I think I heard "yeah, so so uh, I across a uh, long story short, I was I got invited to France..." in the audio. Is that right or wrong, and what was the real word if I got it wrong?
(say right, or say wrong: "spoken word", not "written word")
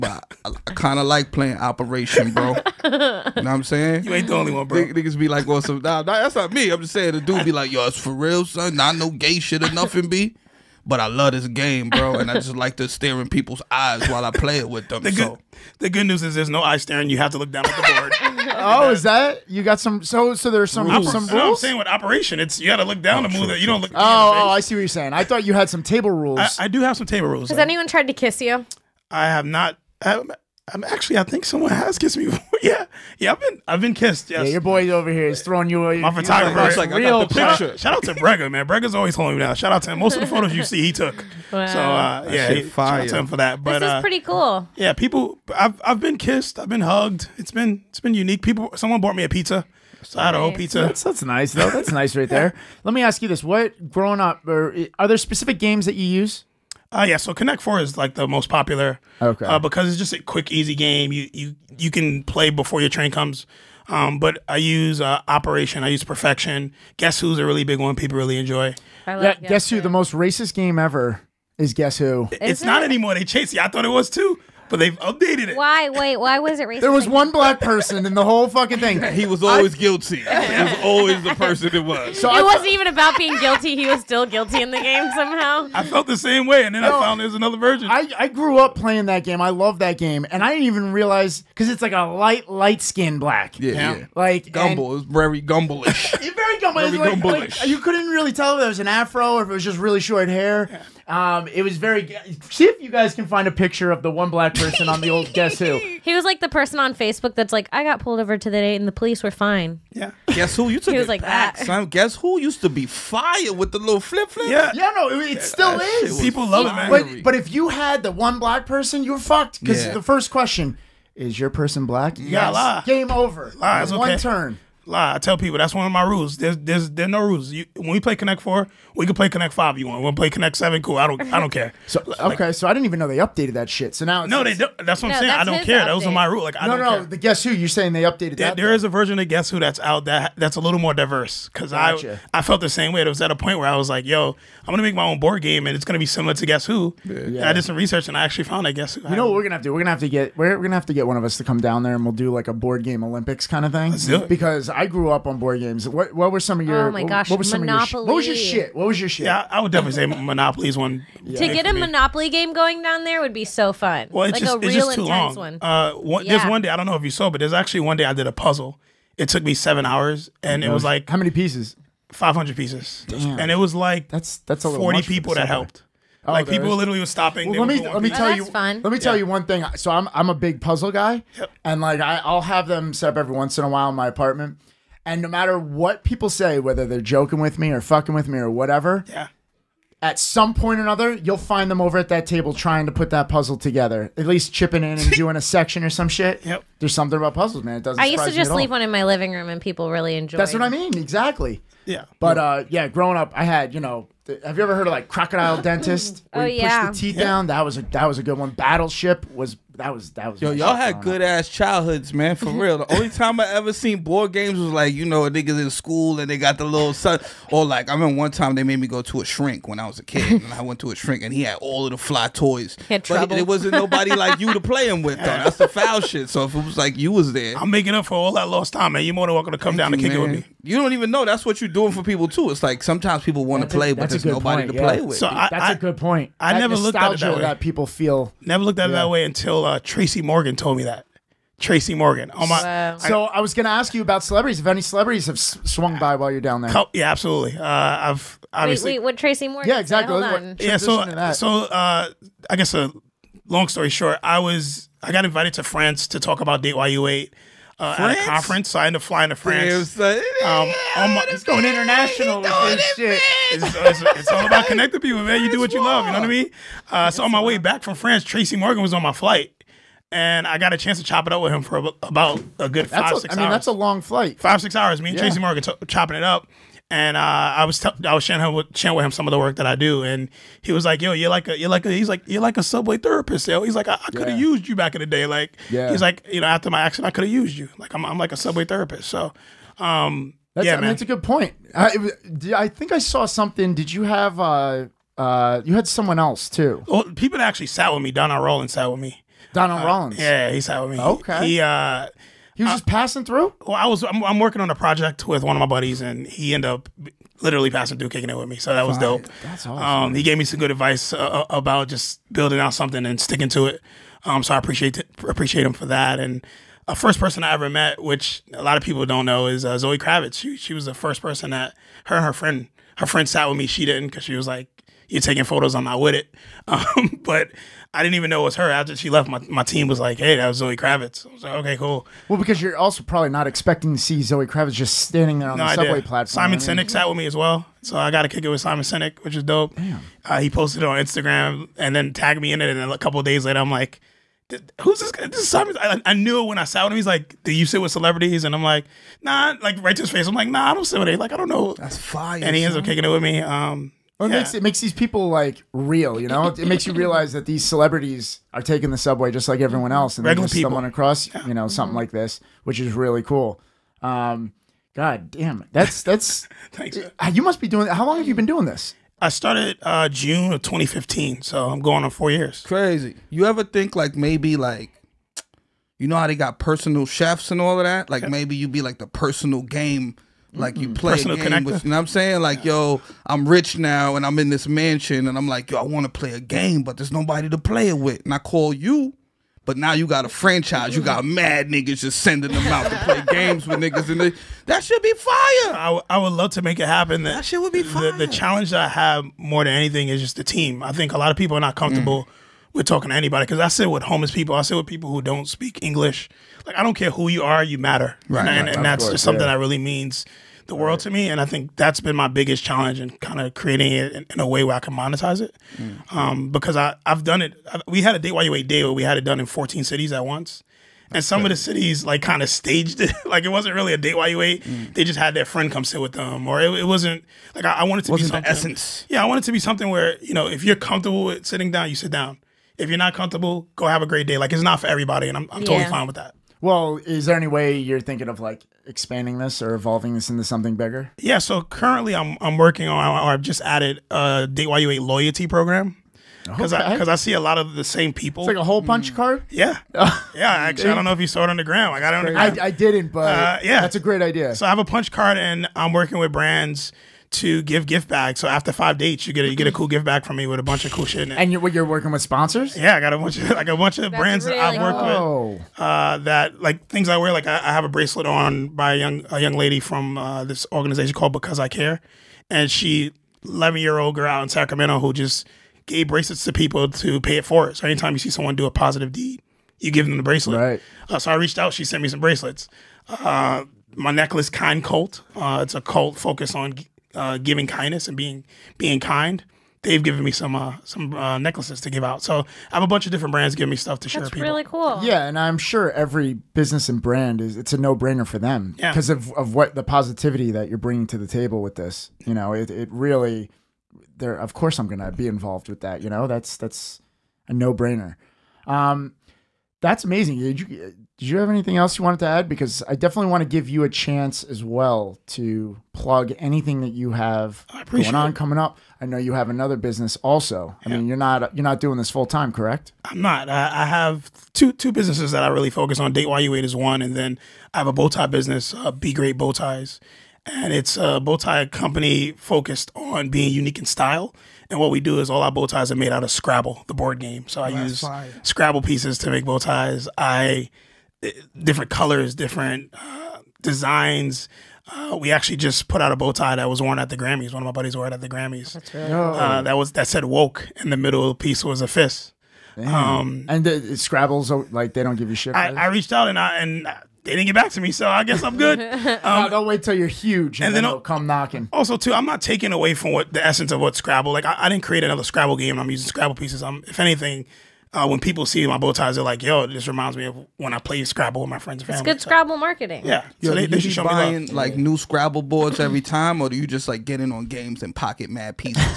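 wrong: "guess", not "across".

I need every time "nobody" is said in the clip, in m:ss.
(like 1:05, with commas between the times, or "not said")
3:43, 3:54, 6:27.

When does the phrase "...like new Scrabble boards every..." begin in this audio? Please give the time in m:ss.
9:34.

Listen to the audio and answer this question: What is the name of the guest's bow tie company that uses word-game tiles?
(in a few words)
Be Great Bow Ties.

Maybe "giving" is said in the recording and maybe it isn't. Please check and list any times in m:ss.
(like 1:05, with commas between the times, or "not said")
8:07, 8:13.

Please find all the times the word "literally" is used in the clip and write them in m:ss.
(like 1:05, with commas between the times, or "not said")
2:56, 5:07.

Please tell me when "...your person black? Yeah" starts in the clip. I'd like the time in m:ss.
2:01.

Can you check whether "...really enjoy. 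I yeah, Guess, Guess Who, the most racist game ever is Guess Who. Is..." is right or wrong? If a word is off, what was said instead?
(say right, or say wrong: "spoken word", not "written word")
right.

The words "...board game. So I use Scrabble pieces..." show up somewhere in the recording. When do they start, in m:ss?
8:56.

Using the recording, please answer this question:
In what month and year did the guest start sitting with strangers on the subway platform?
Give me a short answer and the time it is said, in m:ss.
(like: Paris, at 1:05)
June 2015, at 6:10.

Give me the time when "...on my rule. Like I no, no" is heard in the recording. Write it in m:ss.
2:16.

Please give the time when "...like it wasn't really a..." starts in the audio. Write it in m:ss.
7:03.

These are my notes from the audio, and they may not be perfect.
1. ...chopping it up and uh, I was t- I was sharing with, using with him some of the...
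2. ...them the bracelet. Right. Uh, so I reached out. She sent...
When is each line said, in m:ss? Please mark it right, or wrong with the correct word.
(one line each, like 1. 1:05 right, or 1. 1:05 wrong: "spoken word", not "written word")
1. 4:35 wrong: "sharing", not "using"
2. 8:00 right.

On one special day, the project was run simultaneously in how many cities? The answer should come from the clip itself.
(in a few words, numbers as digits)
14.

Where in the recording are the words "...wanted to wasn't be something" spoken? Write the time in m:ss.
7:07.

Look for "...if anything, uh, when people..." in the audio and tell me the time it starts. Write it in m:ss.
9:26.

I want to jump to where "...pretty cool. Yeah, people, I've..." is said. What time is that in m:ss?
0:44.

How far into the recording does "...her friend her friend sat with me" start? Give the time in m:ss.
5:22.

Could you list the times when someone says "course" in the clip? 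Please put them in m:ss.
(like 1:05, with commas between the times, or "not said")
6:49, 8:24.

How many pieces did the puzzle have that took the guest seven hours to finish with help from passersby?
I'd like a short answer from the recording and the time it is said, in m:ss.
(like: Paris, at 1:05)
500, at 2:52.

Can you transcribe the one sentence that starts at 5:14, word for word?
Um, so I appreciate appreciate him for that.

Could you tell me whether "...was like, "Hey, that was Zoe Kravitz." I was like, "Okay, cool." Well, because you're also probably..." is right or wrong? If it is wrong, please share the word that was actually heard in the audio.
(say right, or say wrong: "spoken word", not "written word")
right.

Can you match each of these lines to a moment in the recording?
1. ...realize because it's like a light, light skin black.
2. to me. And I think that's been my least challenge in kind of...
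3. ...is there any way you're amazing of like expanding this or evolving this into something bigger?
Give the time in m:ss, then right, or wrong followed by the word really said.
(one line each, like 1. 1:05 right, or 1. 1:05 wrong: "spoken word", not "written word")
1. 1:30 right
2. 6:51 wrong: "biggest", not "least"
3. 7:16 wrong: "thinking", not "amazing".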